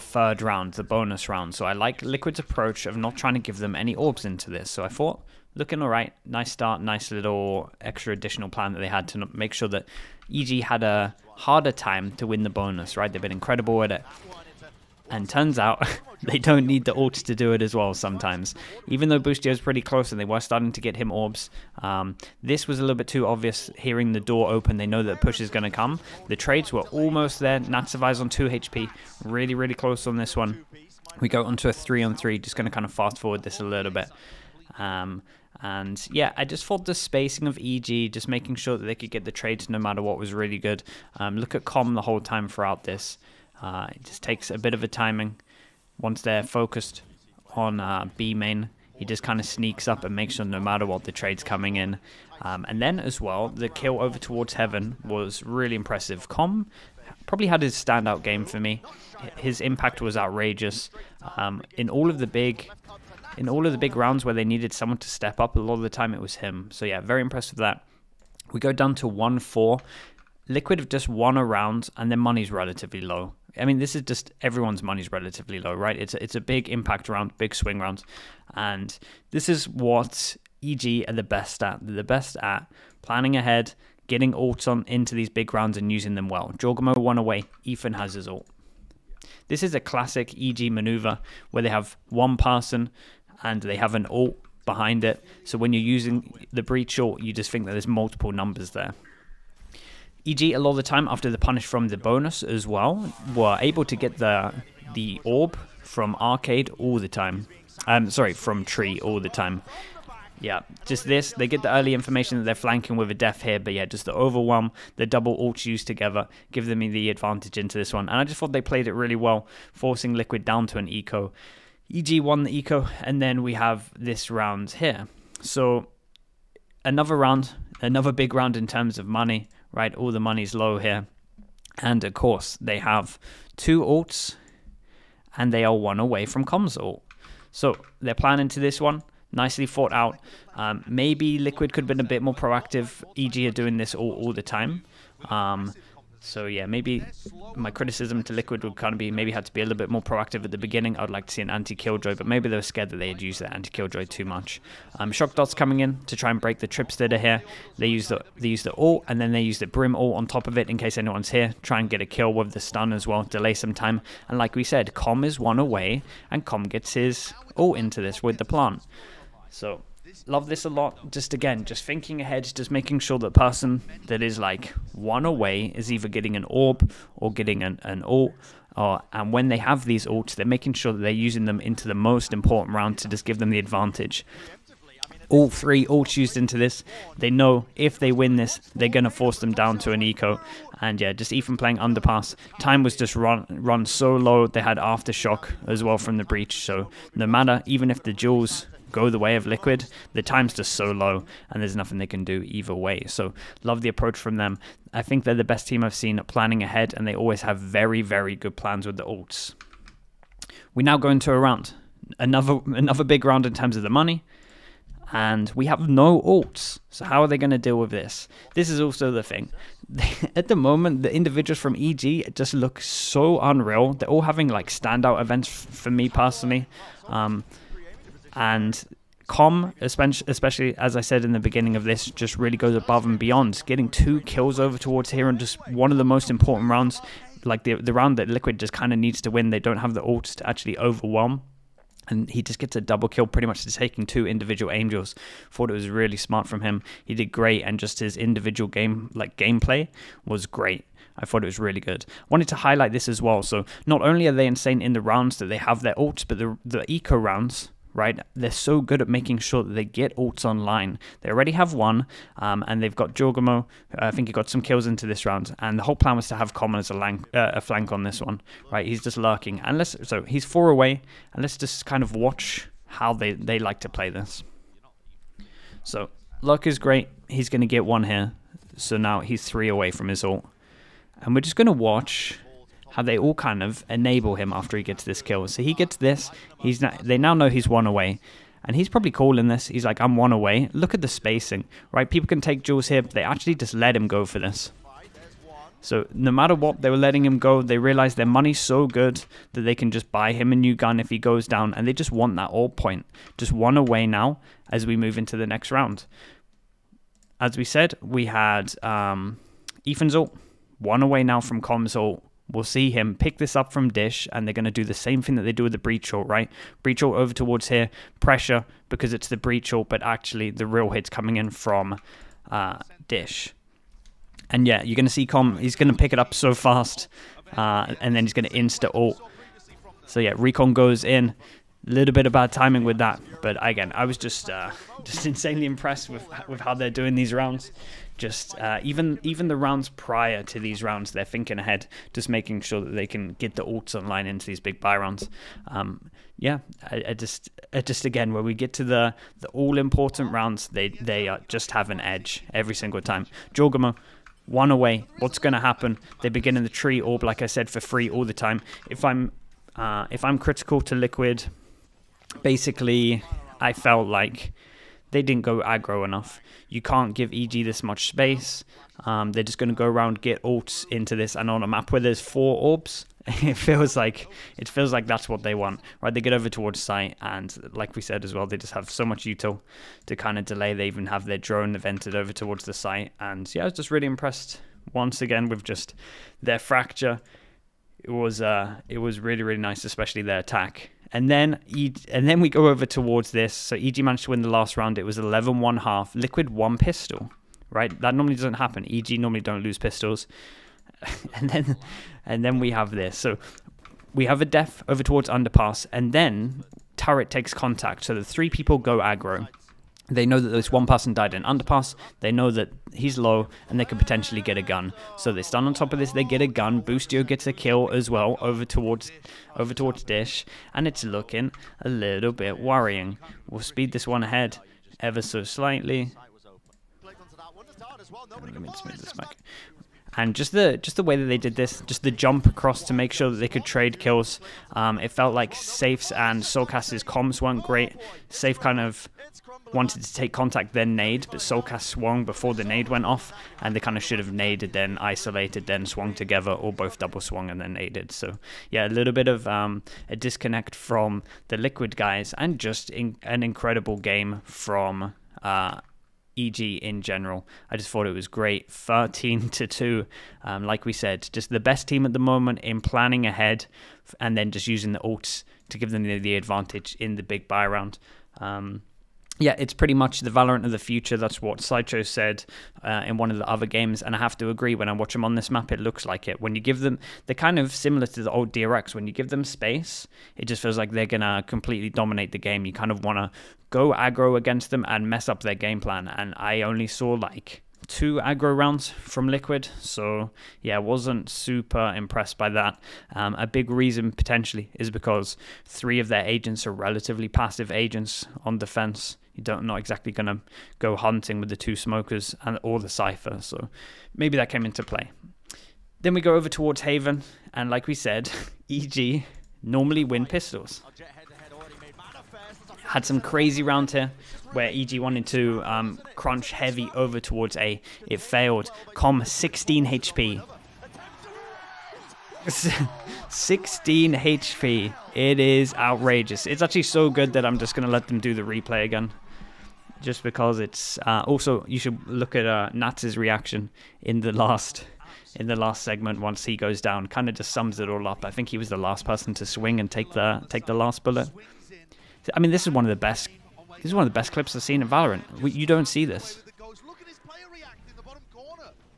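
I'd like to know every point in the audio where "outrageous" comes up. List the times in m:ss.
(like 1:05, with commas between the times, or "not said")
1:00, 8:45.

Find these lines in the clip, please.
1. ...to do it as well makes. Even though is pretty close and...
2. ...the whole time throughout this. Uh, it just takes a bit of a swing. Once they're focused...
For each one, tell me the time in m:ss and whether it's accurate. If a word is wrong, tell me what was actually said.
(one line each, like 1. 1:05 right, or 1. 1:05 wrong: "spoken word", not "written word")
1. 0:17 wrong: "sometimes", not "makes"
2. 0:41 wrong: "timing", not "swing".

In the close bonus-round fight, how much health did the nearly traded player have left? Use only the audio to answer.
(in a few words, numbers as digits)
2.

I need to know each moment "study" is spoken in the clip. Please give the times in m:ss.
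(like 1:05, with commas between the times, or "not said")
not said.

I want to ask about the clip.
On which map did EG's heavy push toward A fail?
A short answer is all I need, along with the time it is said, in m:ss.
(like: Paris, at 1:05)
Haven, at 8:26.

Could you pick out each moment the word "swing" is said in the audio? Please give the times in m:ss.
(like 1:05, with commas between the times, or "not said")
1:17, 8:59.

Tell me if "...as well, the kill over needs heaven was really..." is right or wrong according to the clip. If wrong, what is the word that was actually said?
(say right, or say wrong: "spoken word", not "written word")
wrong: "towards", not "needs".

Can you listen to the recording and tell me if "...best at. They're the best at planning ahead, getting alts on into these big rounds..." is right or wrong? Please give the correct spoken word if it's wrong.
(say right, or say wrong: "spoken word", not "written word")
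right.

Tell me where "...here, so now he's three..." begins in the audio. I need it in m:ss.
4:38.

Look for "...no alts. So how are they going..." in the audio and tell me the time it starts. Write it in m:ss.
3:35.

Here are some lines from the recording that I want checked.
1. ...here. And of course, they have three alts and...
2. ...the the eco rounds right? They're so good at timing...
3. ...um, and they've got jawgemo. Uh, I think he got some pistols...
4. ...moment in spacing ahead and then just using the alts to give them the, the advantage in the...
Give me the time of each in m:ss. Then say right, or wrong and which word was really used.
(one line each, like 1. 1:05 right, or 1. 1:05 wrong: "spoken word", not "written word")
1. 2:10 wrong: "two", not "three"
2. 4:16 wrong: "making", not "timing"
3. 4:22 wrong: "kills", not "pistols"
4. 7:42 wrong: "planning", not "spacing".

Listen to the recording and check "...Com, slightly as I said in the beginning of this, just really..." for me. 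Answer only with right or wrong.
wrong.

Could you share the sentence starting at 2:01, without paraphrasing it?
EG won the eco, and then we have this round here.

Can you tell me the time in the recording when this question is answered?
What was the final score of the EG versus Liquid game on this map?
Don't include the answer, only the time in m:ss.
7:38.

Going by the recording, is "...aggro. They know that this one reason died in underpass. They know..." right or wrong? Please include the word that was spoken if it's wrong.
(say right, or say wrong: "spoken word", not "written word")
wrong: "person", not "reason".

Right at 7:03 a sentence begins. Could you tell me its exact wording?
We'll speed this one ahead ever so slightly.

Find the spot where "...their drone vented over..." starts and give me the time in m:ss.
6:21.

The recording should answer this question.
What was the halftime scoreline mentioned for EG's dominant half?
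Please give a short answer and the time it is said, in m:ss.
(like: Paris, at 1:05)
11-1, at 6:35.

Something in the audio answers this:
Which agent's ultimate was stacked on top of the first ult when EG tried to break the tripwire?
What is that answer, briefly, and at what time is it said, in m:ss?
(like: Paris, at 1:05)
Brim, at 2:39.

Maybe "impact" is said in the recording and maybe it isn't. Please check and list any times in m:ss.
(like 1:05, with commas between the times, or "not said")
0:59, 1:16.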